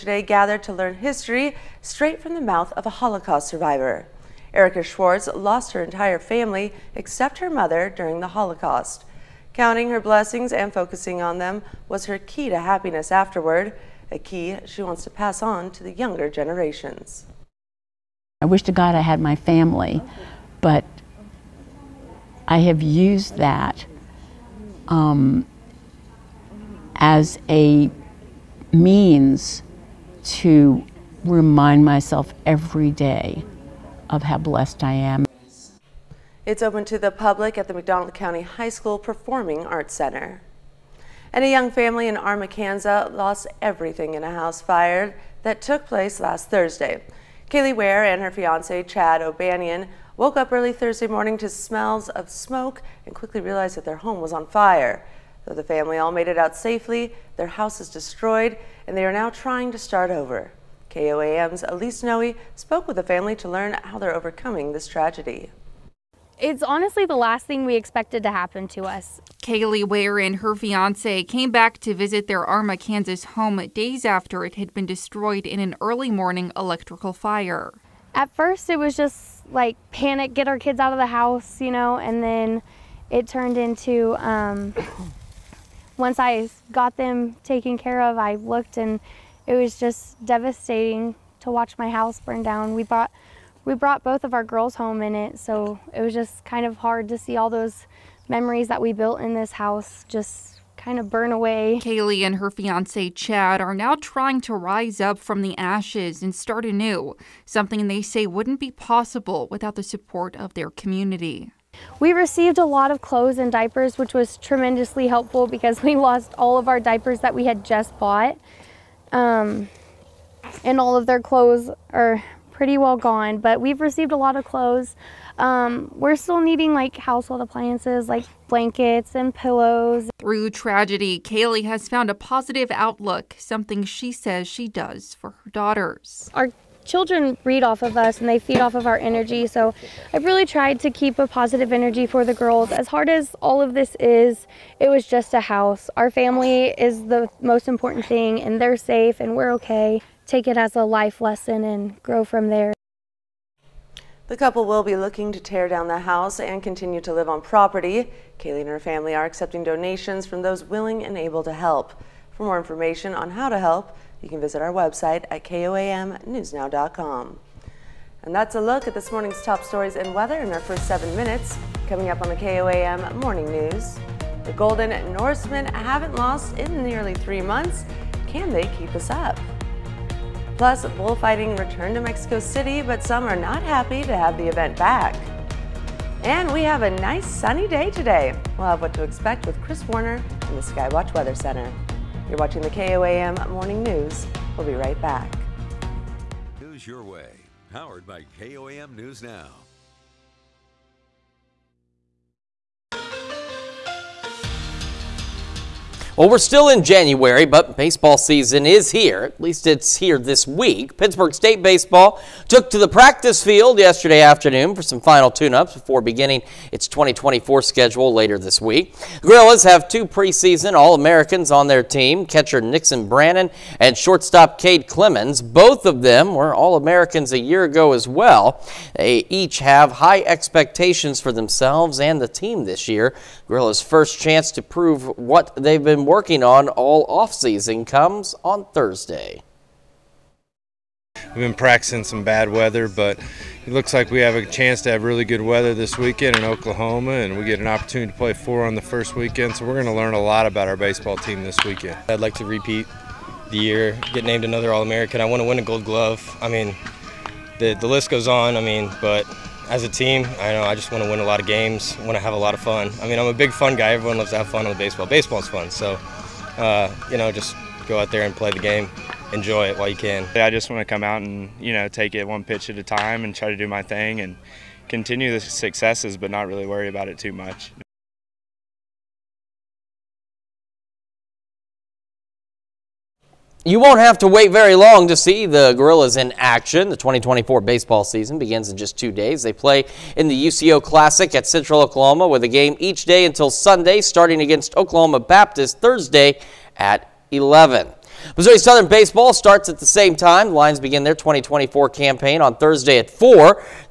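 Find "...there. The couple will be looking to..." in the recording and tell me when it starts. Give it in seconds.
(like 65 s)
152 s.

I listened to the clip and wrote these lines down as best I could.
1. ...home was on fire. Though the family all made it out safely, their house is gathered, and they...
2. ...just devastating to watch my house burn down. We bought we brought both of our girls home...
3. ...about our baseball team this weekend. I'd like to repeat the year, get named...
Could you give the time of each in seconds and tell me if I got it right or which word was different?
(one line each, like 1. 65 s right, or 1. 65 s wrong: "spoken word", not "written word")
1. 53 s wrong: "destroyed", not "gathered"
2. 89 s wrong: "brought", not "bought"
3. 250 s right.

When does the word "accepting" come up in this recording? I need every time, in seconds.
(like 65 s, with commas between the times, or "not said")
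159 s.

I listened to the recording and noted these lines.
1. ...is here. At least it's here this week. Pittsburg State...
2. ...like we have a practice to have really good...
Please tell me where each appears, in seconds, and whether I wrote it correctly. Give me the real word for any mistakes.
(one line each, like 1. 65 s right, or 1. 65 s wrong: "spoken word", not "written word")
1. 208 s right
2. 243 s wrong: "chance", not "practice".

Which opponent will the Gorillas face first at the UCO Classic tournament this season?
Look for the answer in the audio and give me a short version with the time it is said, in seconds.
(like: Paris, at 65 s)
Oklahoma Baptist, at 294 s.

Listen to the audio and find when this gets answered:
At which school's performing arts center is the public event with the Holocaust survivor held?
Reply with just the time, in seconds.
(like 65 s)
37 s.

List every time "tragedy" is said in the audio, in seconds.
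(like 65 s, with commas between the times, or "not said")
64 s, 130 s.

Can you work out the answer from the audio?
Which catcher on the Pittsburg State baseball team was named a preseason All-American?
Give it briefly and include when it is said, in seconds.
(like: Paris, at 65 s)
Nixon Brannon, at 222 s.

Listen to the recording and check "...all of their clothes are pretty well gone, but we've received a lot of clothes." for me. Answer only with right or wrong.
right.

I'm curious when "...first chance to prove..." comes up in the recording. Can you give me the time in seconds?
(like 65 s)
233 s.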